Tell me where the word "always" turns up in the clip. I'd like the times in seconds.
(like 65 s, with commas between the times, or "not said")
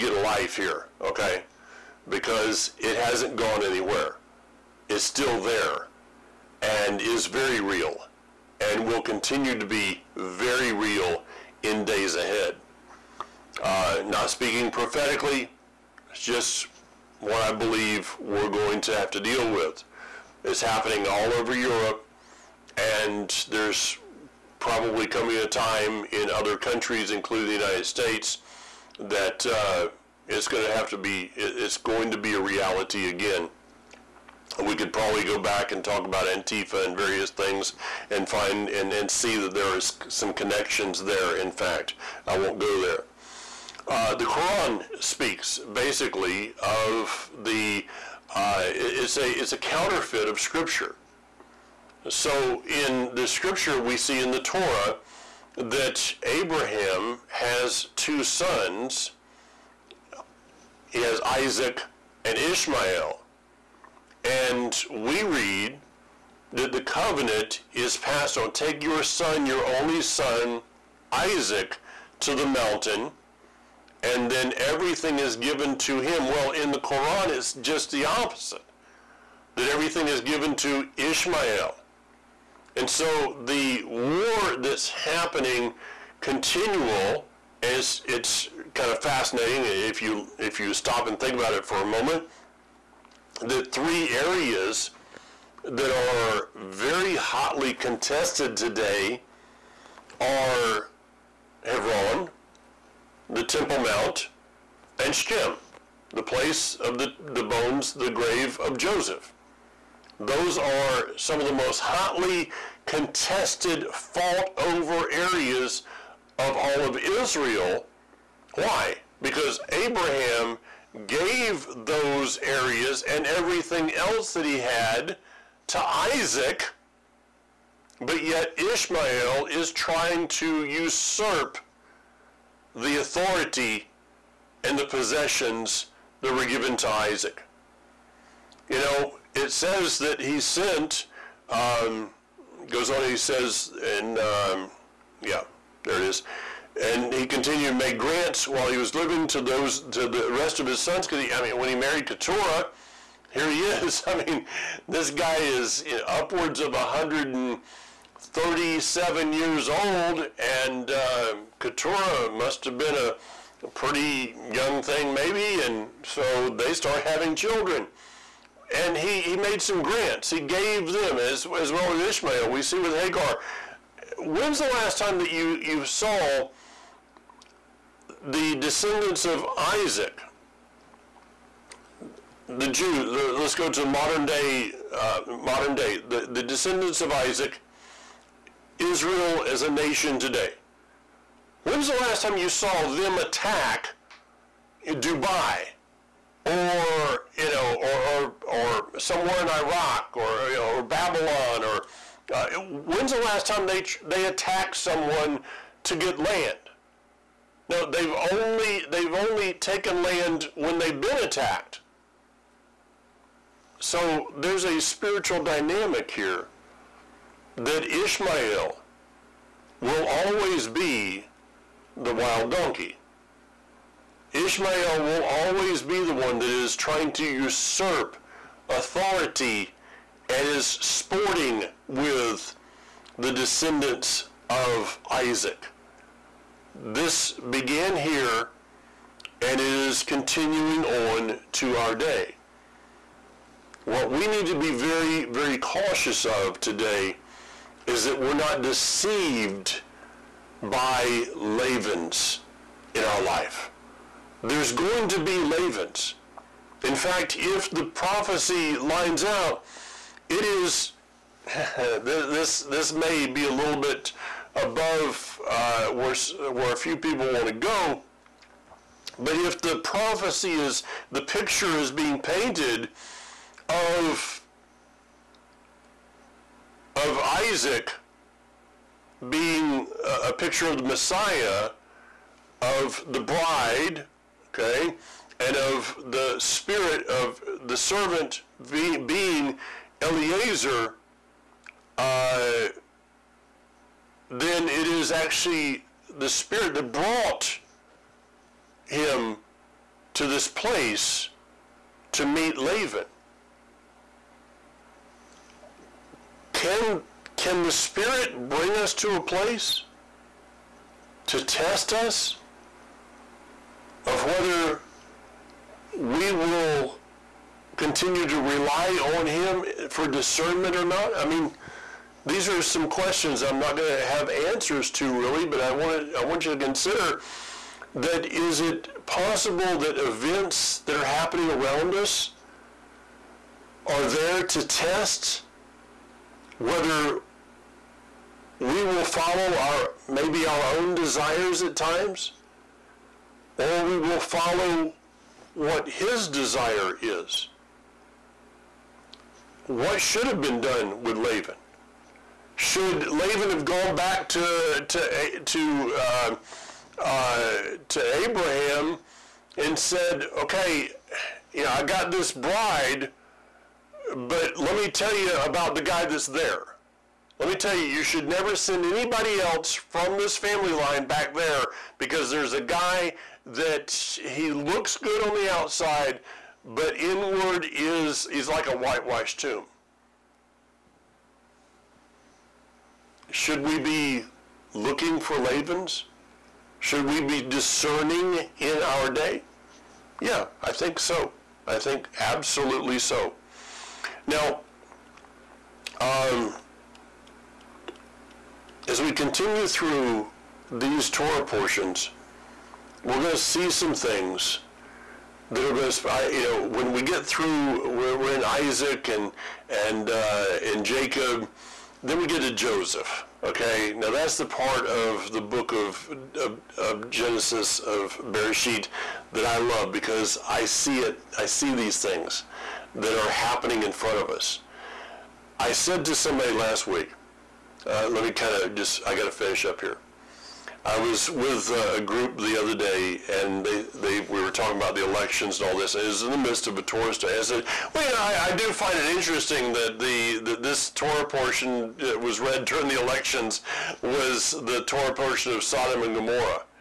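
220 s, 225 s.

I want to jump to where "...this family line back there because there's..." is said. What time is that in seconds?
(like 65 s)
370 s.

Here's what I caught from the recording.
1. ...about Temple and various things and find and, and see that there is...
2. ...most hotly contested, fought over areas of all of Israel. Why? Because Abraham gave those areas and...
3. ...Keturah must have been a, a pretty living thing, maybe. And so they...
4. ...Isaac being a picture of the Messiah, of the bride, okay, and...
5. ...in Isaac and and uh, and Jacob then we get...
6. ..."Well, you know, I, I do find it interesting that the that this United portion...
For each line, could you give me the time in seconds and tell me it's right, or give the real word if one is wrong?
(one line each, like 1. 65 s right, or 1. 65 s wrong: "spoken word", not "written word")
1. 36 s wrong: "Antifa", not "Temple"
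2. 111 s right
3. 161 s wrong: "young", not "living"
4. 277 s right
5. 408 s right
6. 437 s wrong: "Torah", not "United".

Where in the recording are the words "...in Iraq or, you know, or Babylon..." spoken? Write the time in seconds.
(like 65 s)
199 s.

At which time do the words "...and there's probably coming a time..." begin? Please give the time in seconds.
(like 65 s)
22 s.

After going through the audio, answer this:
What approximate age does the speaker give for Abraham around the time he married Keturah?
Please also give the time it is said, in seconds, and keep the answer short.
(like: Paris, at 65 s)
137, at 156 s.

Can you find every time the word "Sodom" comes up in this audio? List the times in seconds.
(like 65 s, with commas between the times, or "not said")
445 s.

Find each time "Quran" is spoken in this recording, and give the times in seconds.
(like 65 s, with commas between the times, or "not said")
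44 s, 76 s.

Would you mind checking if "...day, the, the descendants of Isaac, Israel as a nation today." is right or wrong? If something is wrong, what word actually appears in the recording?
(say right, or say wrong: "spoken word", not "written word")
right.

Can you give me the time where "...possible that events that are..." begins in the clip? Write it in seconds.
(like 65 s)
329 s.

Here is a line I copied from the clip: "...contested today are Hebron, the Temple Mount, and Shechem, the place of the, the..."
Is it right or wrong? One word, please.
right.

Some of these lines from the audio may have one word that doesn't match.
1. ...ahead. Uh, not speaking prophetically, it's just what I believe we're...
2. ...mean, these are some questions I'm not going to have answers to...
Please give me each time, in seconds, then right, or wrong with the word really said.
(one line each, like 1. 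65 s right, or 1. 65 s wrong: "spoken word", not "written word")
1. 12 s right
2. 321 s right.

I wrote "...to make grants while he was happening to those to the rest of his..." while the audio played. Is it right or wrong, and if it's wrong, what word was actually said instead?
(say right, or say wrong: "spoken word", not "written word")
wrong: "living", not "happening".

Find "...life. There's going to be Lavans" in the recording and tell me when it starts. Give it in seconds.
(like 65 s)
253 s.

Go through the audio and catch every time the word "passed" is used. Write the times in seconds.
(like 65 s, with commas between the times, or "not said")
67 s.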